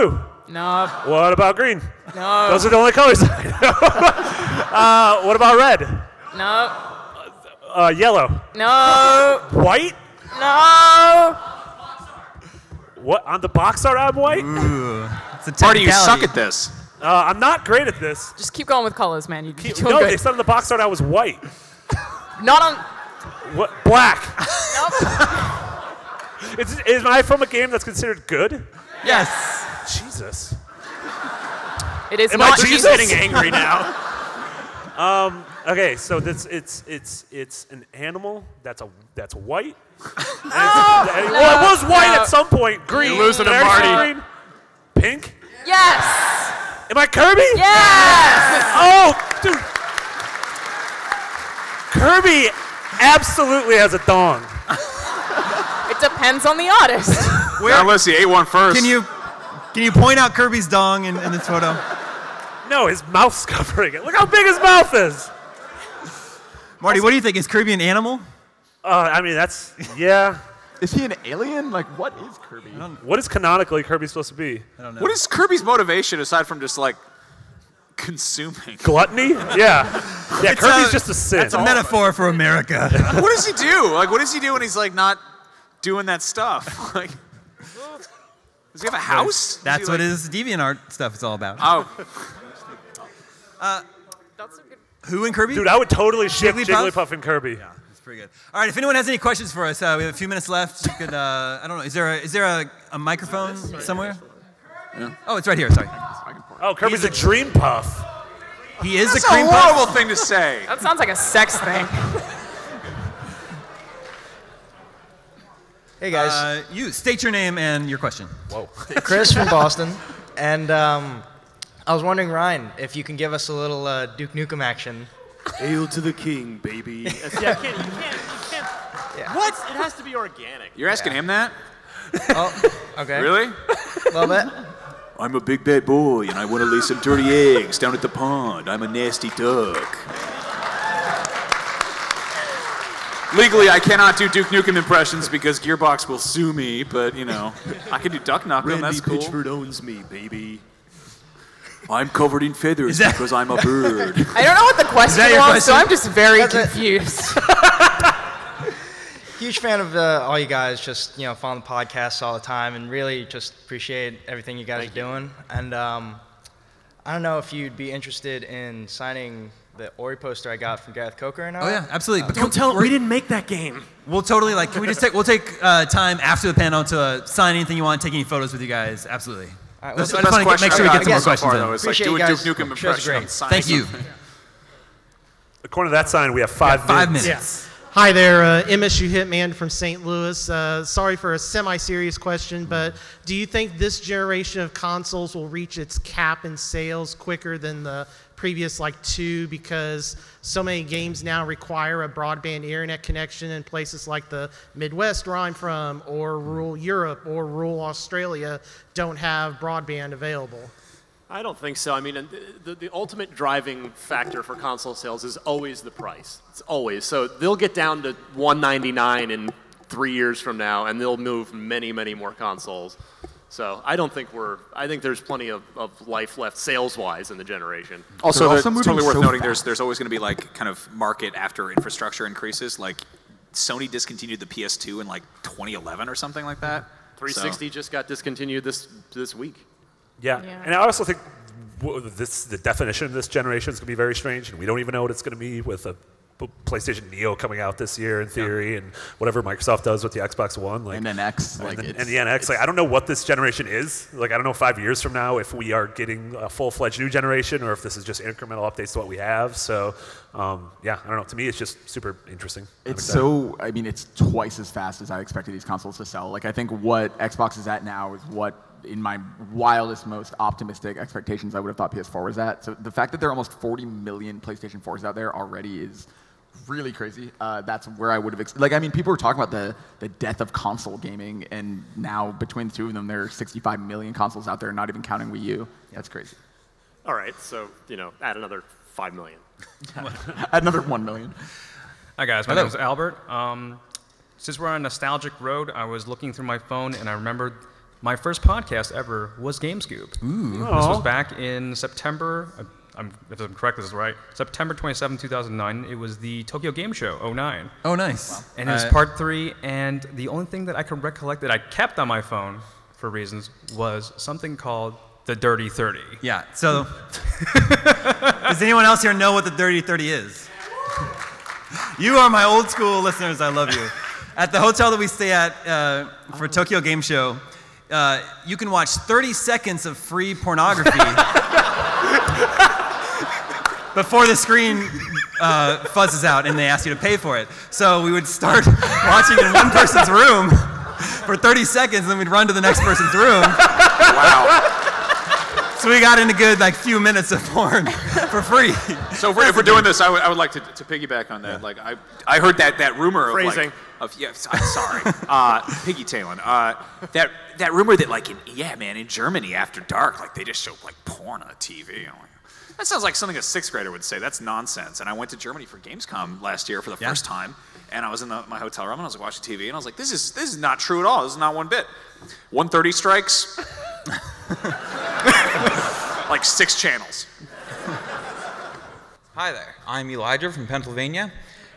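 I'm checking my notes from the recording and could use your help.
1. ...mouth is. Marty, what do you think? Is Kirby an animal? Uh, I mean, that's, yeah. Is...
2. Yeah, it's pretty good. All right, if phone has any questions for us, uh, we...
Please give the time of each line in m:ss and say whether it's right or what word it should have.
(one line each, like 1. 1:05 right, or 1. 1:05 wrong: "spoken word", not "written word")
1. 1:04 right
2. 1:37 wrong: "anyone", not "phone".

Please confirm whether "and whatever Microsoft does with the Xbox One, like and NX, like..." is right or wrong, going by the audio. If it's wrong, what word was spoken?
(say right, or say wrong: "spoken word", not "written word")
right.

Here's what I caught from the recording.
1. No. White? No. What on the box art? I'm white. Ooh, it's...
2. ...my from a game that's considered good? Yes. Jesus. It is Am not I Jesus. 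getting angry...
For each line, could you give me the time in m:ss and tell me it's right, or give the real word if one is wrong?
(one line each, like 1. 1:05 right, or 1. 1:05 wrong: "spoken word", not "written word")
1. 0:08 right
2. 0:27 right.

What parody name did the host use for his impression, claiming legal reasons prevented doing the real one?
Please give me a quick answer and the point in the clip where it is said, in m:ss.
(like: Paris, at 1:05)
Duck Nukem, at 2:28.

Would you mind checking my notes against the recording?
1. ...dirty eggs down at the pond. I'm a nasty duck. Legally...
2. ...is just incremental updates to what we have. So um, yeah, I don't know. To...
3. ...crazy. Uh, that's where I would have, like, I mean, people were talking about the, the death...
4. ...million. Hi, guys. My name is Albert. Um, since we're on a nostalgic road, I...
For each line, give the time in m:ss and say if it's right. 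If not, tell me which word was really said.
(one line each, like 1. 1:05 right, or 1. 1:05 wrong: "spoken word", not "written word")
1. 2:16 right
2. 4:17 right
3. 4:36 right
4. 4:51 right.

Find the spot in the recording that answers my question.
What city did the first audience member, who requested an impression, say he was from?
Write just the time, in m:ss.
1:59.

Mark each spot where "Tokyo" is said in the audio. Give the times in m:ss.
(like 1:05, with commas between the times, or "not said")
5:06, 5:26.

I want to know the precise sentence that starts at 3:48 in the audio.
Also, also it's totally worth so noting.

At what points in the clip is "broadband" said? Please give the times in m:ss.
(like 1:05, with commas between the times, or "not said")
3:22, 3:29.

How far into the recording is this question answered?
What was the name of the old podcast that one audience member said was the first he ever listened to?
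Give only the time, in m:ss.
4:59.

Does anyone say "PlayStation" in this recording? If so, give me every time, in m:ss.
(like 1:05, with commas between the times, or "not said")
4:06, 4:34.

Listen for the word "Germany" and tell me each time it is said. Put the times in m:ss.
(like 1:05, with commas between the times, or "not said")
5:59, 6:05.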